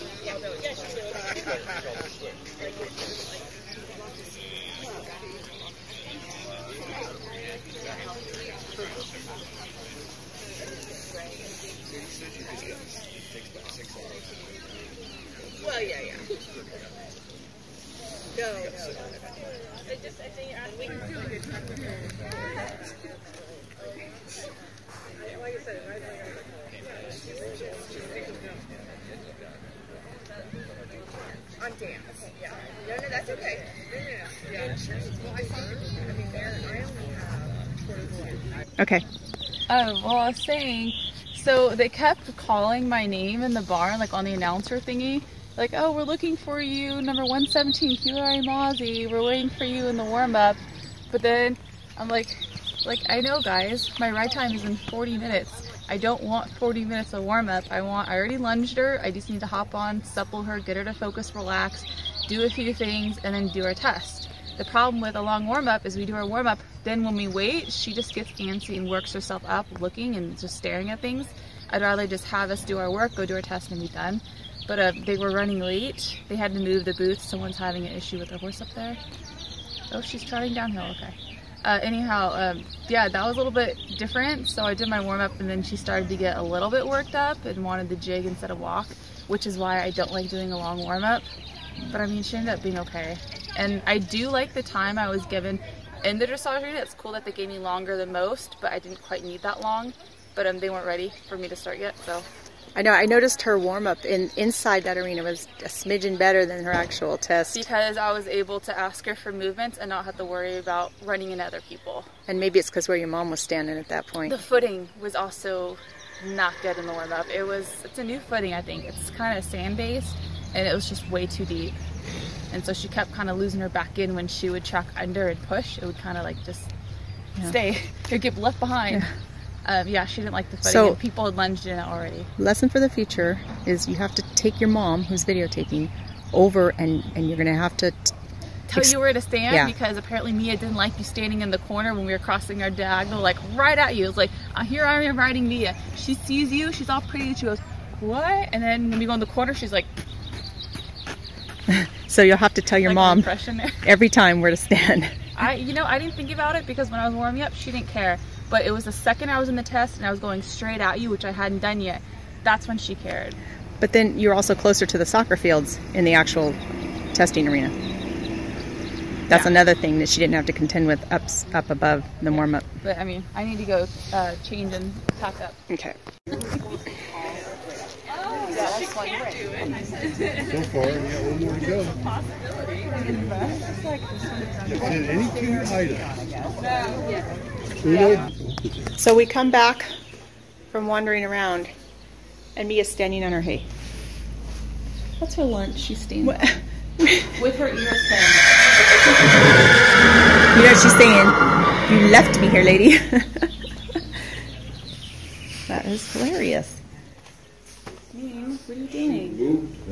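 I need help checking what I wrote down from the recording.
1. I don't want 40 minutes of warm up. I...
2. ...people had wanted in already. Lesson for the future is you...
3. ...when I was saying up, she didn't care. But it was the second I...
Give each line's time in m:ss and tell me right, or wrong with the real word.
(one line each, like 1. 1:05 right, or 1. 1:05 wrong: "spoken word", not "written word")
1. 0:55 right
2. 2:10 wrong: "lunged", not "wanted"
3. 2:36 wrong: "warming", not "saying".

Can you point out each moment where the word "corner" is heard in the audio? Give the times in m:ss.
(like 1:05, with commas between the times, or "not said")
2:21, 2:29.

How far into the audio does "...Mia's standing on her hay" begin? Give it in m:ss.
3:12.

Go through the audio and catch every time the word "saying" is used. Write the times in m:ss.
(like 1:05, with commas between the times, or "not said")
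0:40, 3:20.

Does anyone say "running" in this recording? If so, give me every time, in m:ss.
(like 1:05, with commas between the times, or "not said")
1:15, 1:51.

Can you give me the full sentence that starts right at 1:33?
And I do like the time I was given in the dressage arena.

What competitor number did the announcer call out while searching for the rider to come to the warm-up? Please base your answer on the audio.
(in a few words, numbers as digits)
117.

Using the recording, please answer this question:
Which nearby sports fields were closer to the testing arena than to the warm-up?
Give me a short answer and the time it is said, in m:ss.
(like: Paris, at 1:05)
Soccer fields, at 2:45.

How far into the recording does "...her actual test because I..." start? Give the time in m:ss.
1:46.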